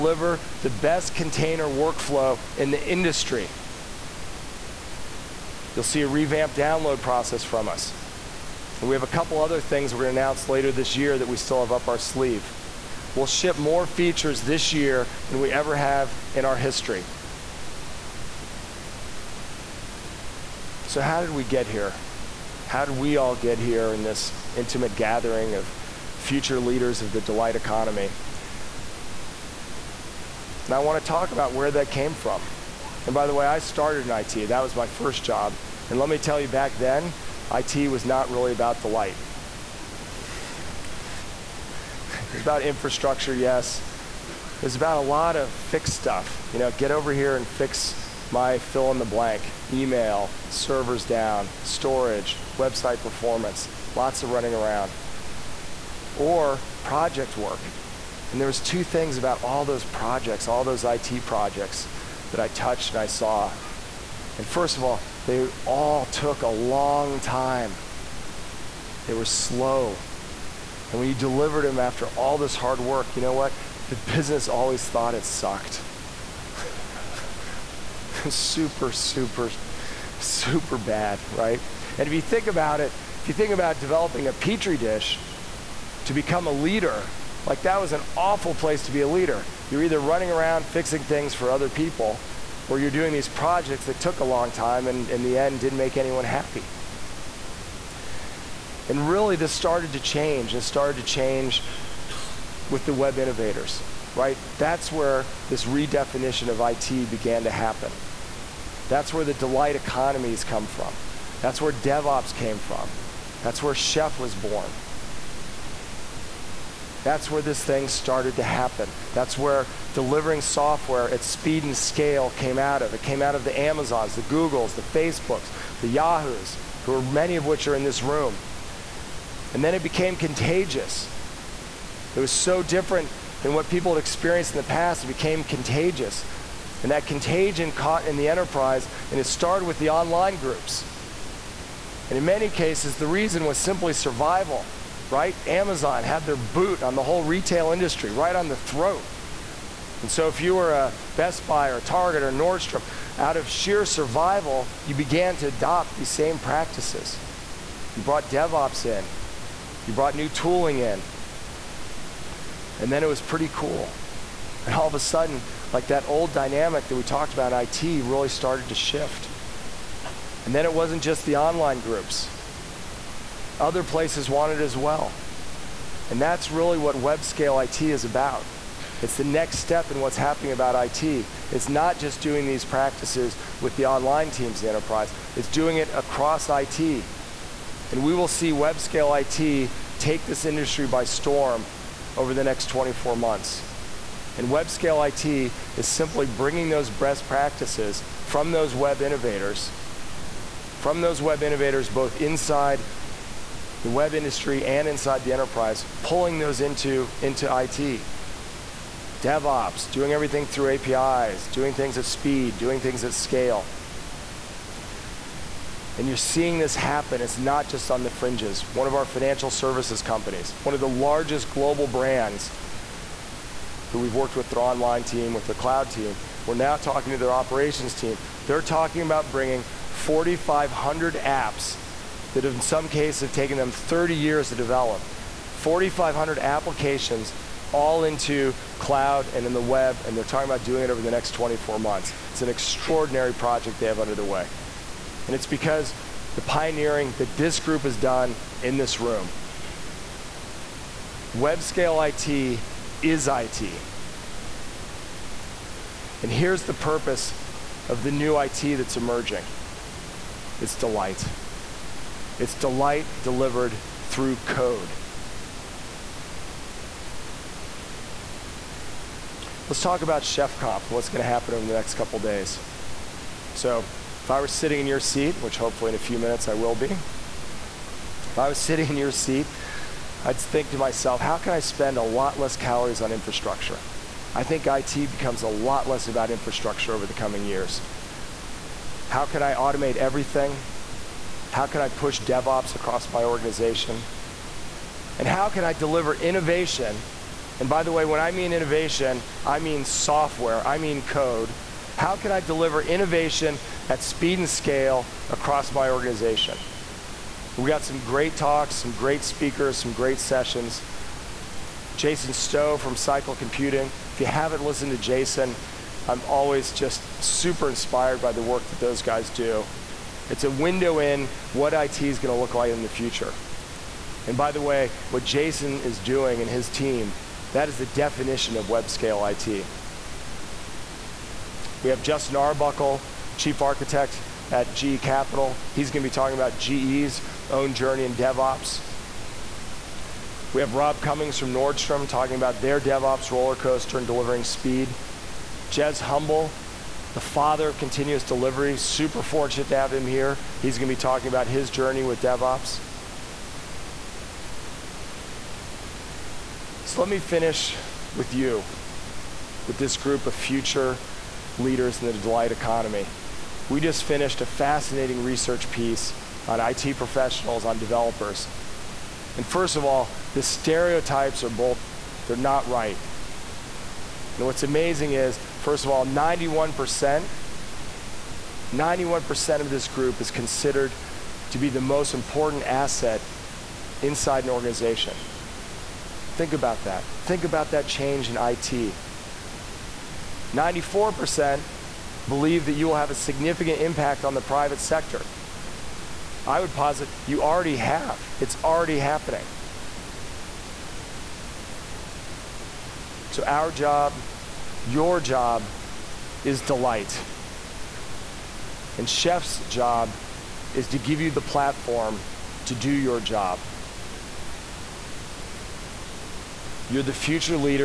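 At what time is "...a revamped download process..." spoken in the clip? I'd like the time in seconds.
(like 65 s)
6 s.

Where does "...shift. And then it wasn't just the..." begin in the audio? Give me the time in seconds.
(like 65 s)
168 s.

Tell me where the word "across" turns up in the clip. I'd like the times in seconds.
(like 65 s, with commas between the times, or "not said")
185 s, 292 s, 305 s.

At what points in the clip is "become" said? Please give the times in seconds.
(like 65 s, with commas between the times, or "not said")
86 s, 285 s.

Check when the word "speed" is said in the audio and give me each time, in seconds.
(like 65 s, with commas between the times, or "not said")
121 s, 212 s, 304 s, 344 s.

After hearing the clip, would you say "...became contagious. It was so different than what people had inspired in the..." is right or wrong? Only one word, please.
wrong.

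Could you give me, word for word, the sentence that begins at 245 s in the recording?
And it's because the pioneering that this group has done in this room.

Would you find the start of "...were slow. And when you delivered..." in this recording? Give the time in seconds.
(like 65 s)
69 s.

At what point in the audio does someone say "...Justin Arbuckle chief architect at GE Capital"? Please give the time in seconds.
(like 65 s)
332 s.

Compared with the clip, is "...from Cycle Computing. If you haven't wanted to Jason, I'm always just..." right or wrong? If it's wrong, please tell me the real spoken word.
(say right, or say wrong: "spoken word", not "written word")
wrong: "listened", not "wanted".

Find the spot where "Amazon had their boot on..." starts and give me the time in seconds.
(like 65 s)
145 s.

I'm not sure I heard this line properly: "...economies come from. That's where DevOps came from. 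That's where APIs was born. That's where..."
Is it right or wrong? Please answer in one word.
wrong.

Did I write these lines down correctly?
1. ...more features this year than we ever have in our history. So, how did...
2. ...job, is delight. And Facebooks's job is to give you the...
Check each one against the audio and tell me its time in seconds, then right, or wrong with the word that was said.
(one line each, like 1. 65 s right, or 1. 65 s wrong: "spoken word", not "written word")
1. 13 s right
2. 405 s wrong: "Chef", not "Facebooks".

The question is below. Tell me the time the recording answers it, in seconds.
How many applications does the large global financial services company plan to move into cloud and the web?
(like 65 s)
229 s.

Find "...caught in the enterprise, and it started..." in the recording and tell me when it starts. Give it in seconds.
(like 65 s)
137 s.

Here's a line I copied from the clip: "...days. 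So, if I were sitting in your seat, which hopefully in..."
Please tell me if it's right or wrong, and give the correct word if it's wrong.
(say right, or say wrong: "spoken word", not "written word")
right.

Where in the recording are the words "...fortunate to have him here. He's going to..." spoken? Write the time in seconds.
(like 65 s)
349 s.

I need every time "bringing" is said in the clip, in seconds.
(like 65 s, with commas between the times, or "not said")
196 s, 229 s.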